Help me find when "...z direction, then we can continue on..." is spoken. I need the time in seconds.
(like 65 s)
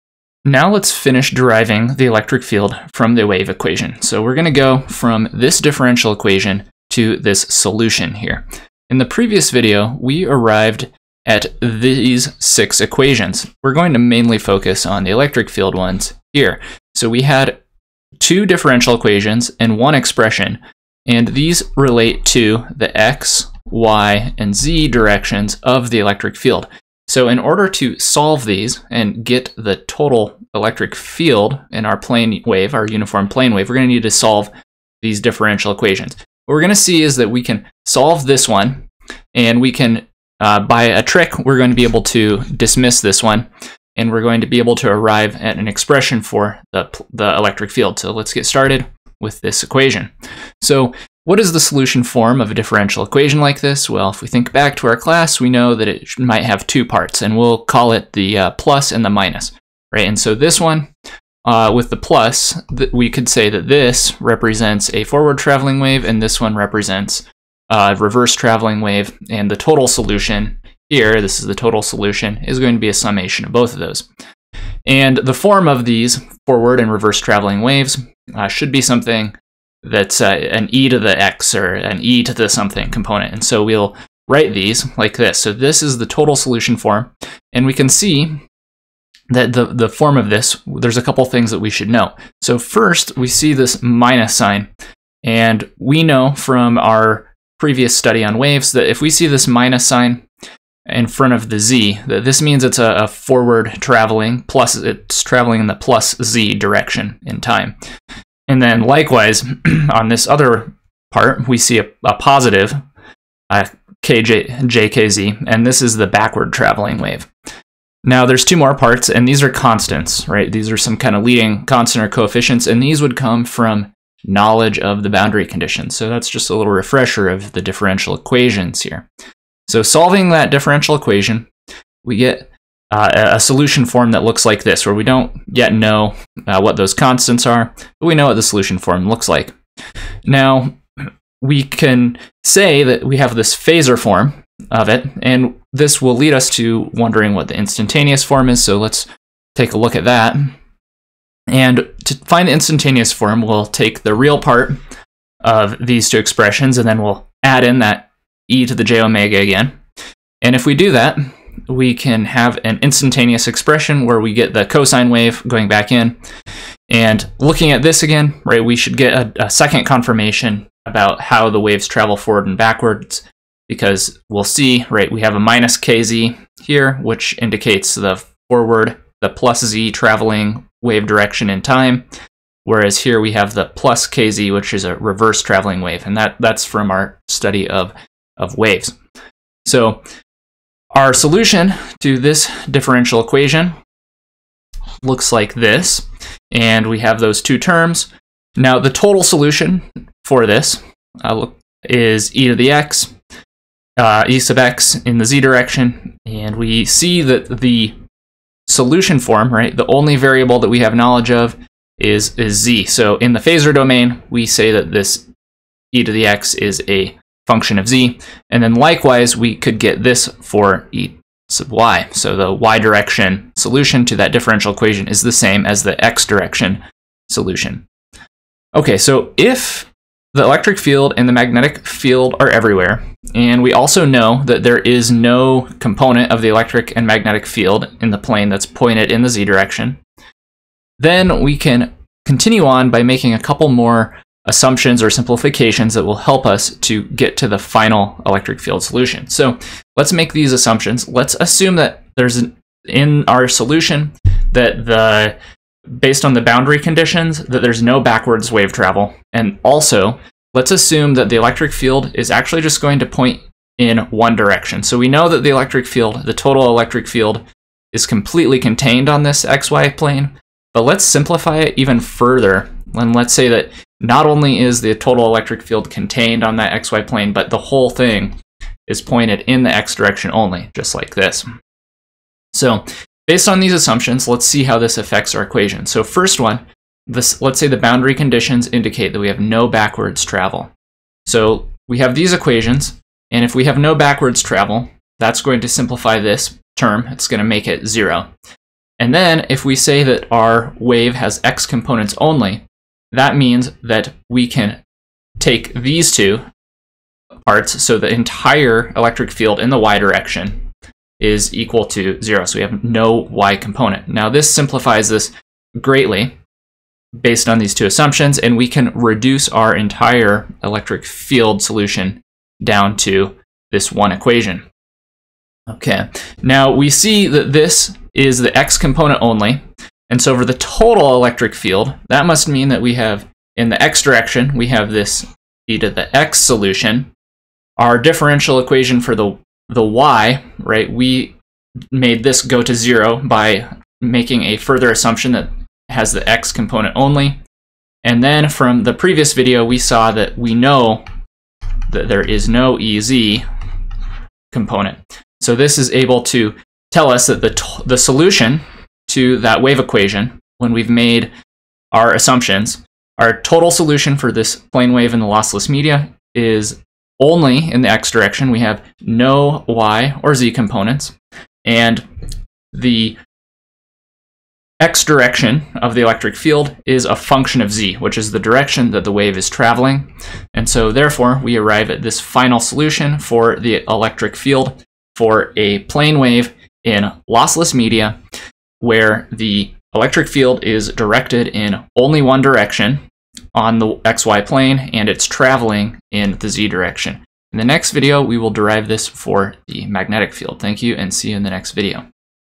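239 s.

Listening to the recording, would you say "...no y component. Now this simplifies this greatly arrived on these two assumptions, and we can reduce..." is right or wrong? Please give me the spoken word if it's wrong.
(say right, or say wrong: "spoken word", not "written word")
wrong: "based", not "arrived".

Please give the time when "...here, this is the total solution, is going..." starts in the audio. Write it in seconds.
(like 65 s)
70 s.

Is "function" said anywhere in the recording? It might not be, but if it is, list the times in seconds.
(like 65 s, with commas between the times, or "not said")
217 s, 377 s.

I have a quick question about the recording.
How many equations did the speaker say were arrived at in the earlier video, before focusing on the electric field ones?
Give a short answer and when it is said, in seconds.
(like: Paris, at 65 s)
6, at 12 s.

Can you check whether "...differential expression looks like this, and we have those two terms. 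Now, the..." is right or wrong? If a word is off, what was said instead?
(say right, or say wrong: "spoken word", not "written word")
wrong: "equation", not "expression".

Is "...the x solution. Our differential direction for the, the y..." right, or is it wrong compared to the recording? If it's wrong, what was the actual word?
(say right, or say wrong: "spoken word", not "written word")
wrong: "equation", not "direction".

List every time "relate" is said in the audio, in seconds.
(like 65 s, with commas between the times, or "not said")
21 s.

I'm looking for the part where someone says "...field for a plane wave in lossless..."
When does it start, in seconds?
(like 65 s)
384 s.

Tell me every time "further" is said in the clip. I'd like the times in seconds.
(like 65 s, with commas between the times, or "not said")
271 s, 344 s.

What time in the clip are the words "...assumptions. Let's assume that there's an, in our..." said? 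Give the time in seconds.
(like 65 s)
250 s.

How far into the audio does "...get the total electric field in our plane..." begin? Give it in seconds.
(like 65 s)
29 s.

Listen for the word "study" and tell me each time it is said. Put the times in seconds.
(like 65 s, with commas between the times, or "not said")
97 s, 187 s.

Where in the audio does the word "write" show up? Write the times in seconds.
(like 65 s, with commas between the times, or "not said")
84 s.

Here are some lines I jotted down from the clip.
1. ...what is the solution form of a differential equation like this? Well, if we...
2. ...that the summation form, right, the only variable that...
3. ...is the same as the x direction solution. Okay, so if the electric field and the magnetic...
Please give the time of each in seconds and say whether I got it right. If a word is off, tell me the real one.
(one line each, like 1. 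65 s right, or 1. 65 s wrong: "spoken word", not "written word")
1. 51 s right
2. 207 s wrong: "solution", not "summation"
3. 225 s right.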